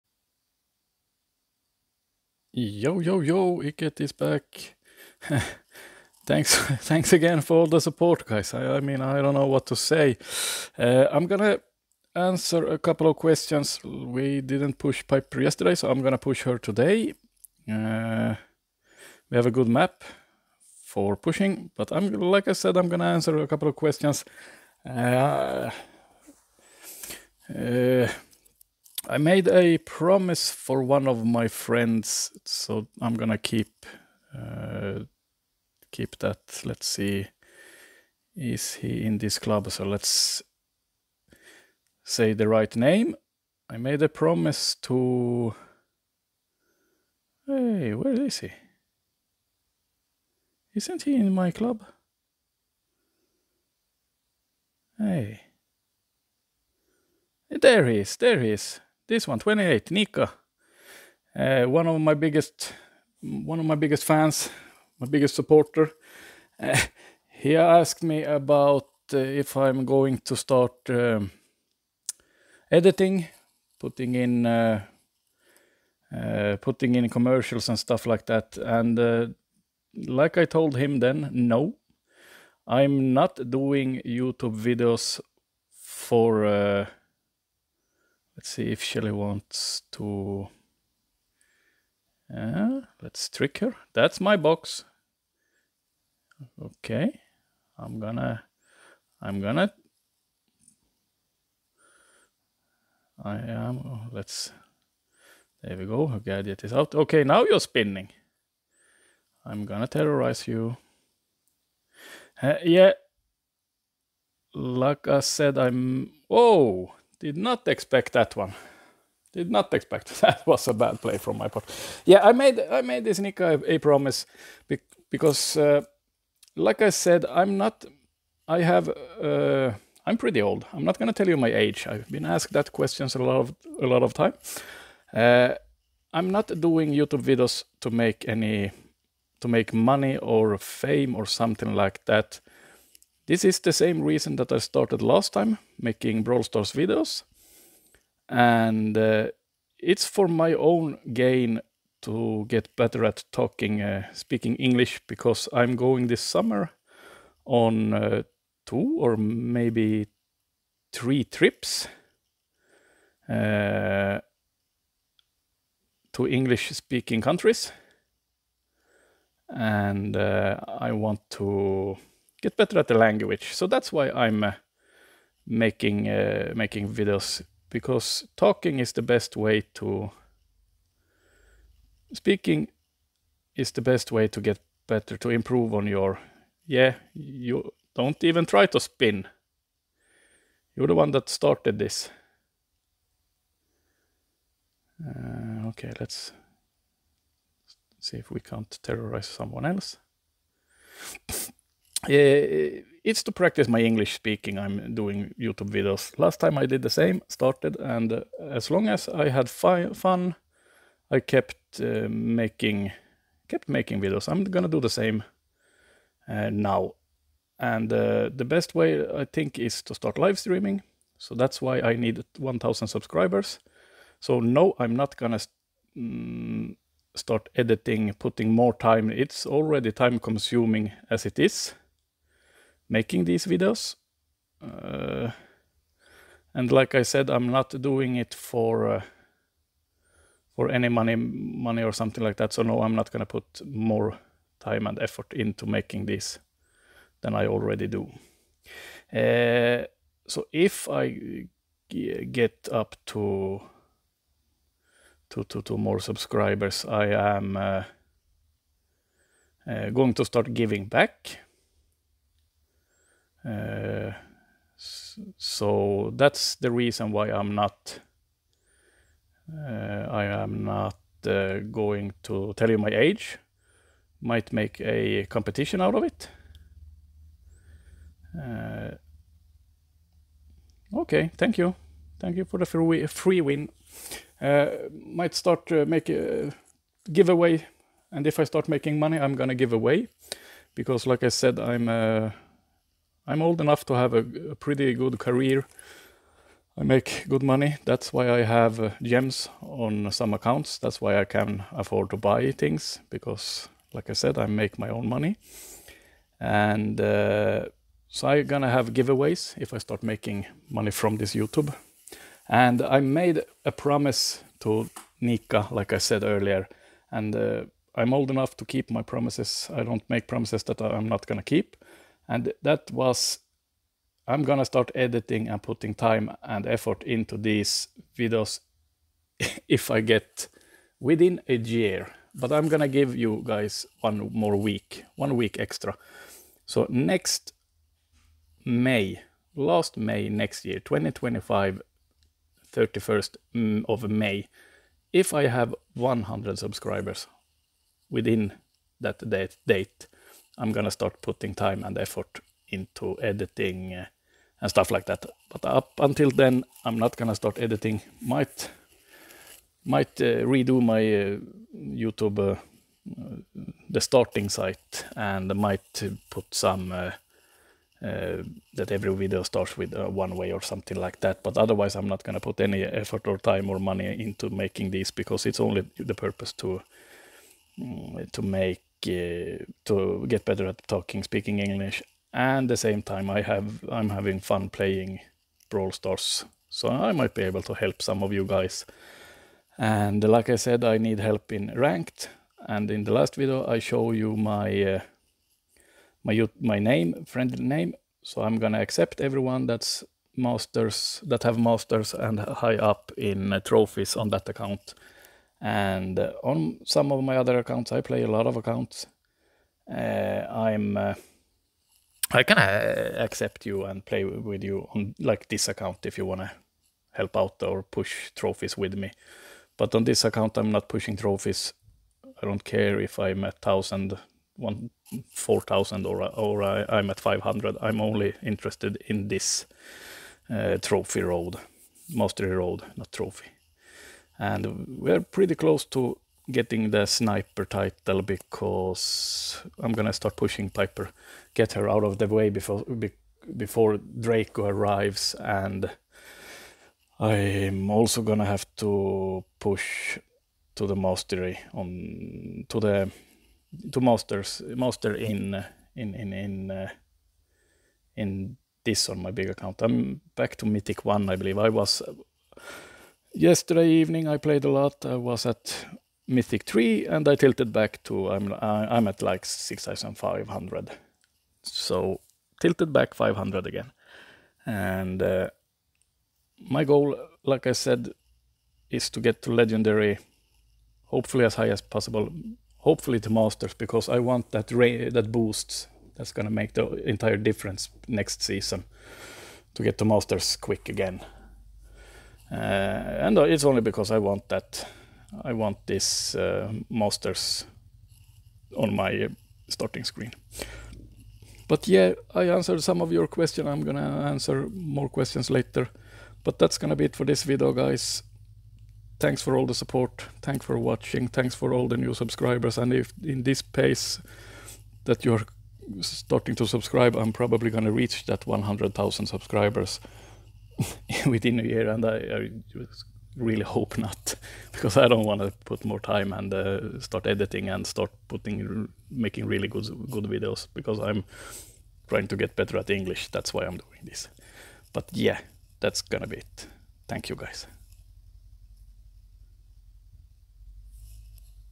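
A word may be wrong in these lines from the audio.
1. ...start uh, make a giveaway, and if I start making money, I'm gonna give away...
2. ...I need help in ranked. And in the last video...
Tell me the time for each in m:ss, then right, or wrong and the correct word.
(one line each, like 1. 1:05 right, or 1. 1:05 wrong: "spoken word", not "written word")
1. 4:45 right
2. 6:30 right.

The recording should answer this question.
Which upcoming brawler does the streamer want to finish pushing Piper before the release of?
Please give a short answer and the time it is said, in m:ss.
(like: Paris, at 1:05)
Draco, at 7:23.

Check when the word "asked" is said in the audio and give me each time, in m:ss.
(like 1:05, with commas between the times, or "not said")
1:07, 2:12.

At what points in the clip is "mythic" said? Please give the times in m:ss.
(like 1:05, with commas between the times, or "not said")
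7:40, 7:46.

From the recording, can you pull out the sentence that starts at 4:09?
Uh, so if I get up to to to, to more subscribers, I am uh, uh, going to start giving back.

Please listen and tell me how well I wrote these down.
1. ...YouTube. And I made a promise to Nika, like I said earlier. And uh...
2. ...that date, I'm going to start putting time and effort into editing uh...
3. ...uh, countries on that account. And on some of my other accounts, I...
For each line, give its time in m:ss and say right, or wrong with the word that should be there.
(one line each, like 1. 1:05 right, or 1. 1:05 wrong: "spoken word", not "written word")
1. 5:11 right
2. 5:49 right
3. 6:43 wrong: "trophies", not "countries".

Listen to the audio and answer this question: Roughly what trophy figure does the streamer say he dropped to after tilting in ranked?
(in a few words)
6,500.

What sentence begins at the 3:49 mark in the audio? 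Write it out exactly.
It's already time consuming as it is making these videos.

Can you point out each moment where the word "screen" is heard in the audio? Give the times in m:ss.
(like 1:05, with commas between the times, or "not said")
8:20.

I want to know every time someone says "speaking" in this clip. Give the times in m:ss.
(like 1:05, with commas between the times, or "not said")
2:34, 2:46, 3:02, 3:24, 6:21.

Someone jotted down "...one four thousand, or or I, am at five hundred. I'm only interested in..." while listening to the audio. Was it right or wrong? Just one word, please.
right.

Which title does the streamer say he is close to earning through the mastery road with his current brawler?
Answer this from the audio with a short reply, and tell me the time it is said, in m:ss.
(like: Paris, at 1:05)
sniper title, at 7:17.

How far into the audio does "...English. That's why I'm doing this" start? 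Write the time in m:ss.
8:52.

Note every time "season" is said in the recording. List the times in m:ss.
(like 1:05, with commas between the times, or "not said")
8:08.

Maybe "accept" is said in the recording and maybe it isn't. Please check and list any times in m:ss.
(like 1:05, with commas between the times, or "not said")
6:38, 6:53.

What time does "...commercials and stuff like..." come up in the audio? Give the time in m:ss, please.
1:17.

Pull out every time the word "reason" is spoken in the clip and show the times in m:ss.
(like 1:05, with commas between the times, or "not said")
2:24, 4:26.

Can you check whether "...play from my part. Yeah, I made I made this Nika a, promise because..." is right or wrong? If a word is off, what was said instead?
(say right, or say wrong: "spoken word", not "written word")
right.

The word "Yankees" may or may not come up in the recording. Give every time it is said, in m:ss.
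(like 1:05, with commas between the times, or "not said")
not said.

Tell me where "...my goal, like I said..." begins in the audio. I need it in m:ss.
7:56.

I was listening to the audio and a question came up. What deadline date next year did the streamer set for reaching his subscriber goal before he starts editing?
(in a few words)
May 31, 2025.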